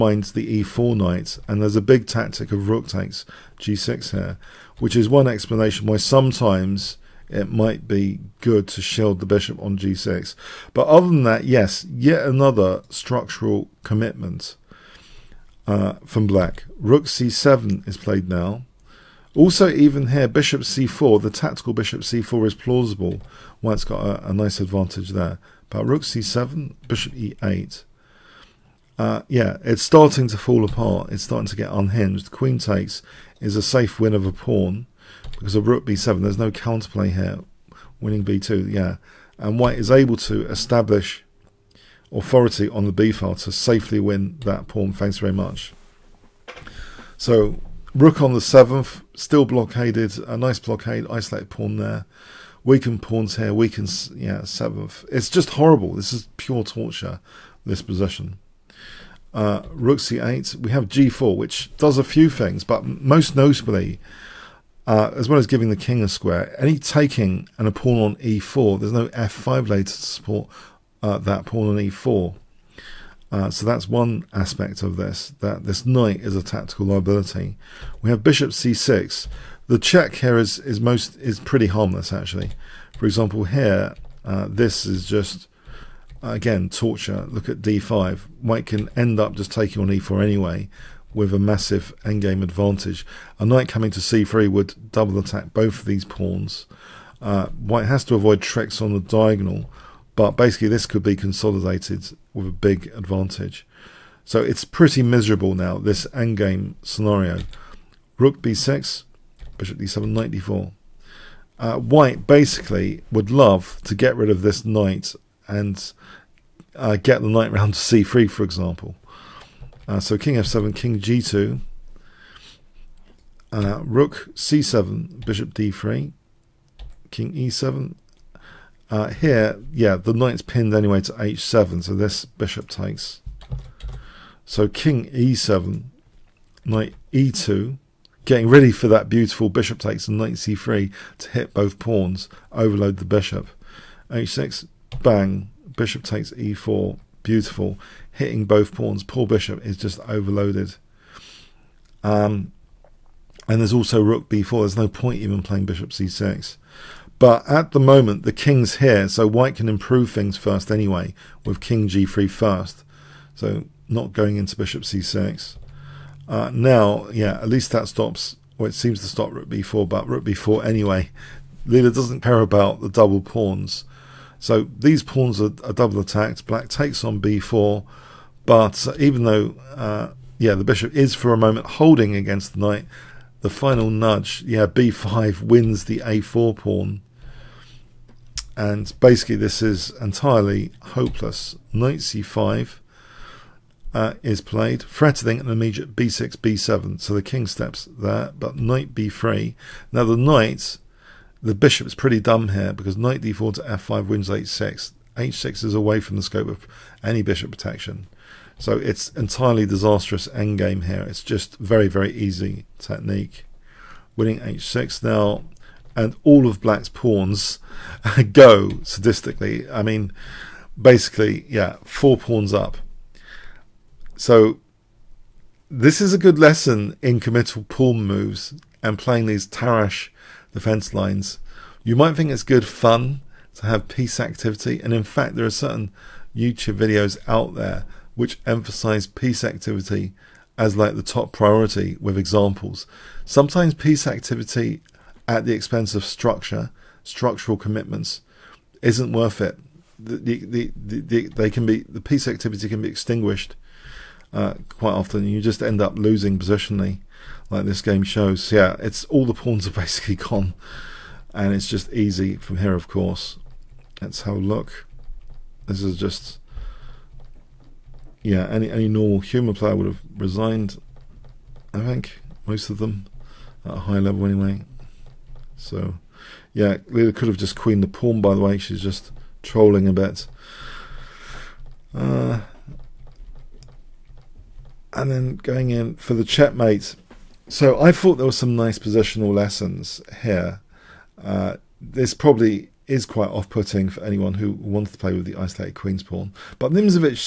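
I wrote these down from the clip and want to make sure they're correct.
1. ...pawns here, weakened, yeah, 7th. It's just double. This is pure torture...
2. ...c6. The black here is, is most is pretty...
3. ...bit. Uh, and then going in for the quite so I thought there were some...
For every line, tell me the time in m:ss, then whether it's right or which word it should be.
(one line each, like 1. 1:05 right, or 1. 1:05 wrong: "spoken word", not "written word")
1. 0:53 wrong: "horrible", not "double"
2. 1:18 wrong: "check", not "black"
3. 4:39 wrong: "checkmate", not "quite".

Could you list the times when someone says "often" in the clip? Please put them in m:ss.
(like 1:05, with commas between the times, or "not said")
4:14.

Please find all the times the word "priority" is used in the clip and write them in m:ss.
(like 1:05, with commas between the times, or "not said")
4:01.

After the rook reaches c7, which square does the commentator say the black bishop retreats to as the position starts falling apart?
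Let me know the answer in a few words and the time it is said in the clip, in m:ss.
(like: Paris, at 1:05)
e8, at 0:26.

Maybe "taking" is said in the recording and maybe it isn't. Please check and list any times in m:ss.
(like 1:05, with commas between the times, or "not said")
1:06, 1:29.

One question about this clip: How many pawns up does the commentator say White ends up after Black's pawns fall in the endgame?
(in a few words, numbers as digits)
4.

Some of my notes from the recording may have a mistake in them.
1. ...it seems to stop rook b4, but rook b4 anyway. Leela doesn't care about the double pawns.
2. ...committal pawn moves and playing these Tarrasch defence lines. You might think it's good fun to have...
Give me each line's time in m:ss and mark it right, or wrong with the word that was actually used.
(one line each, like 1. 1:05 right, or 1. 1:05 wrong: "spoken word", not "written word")
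1. 2:48 right
2. 3:47 right.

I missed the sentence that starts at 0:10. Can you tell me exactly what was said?
But other than that, yes, yet another structural commitment uh, from black.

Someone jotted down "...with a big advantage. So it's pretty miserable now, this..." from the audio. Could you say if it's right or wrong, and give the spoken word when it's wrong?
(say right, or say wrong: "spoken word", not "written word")
right.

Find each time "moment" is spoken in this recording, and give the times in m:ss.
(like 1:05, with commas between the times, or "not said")
2:37, 3:01.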